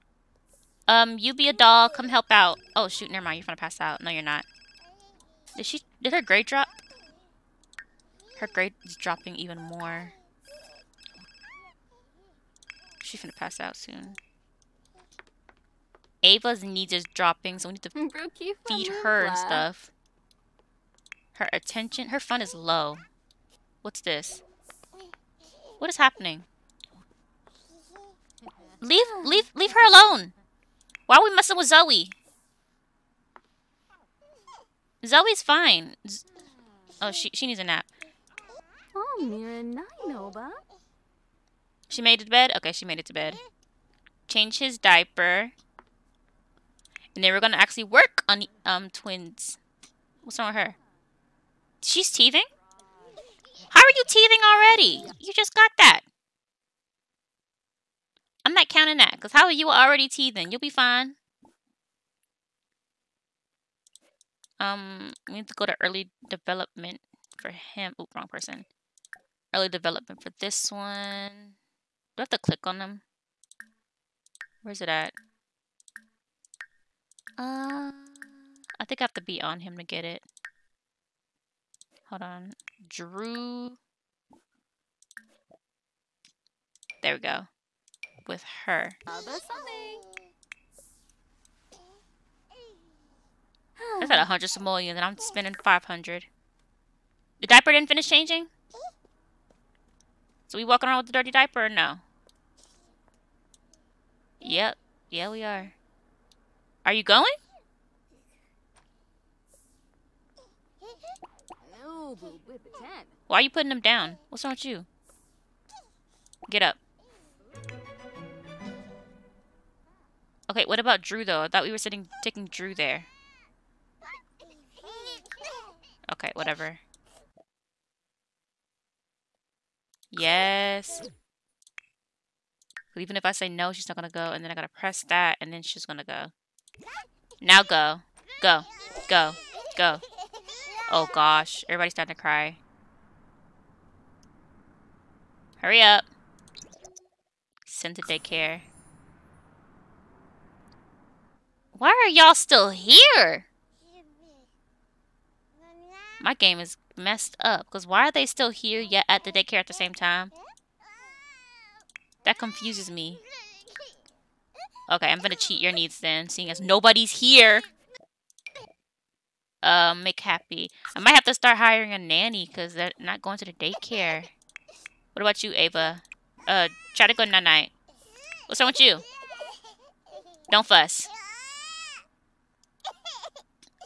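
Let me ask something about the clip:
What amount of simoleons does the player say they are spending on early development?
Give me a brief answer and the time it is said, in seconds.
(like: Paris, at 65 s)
500, at 95 s.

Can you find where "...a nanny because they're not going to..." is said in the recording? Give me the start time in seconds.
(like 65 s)
171 s.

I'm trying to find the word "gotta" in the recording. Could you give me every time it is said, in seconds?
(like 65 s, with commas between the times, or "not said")
134 s.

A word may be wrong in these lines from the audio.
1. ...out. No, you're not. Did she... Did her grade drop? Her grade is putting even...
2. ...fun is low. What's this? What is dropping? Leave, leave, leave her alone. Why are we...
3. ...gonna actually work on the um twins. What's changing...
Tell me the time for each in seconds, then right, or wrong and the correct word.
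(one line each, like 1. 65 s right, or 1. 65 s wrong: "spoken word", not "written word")
1. 3 s wrong: "dropping", not "putting"
2. 22 s wrong: "happening", not "dropping"
3. 47 s wrong: "wrong", not "changing".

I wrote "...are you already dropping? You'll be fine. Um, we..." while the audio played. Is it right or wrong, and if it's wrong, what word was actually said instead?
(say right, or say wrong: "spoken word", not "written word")
wrong: "teething", not "dropping".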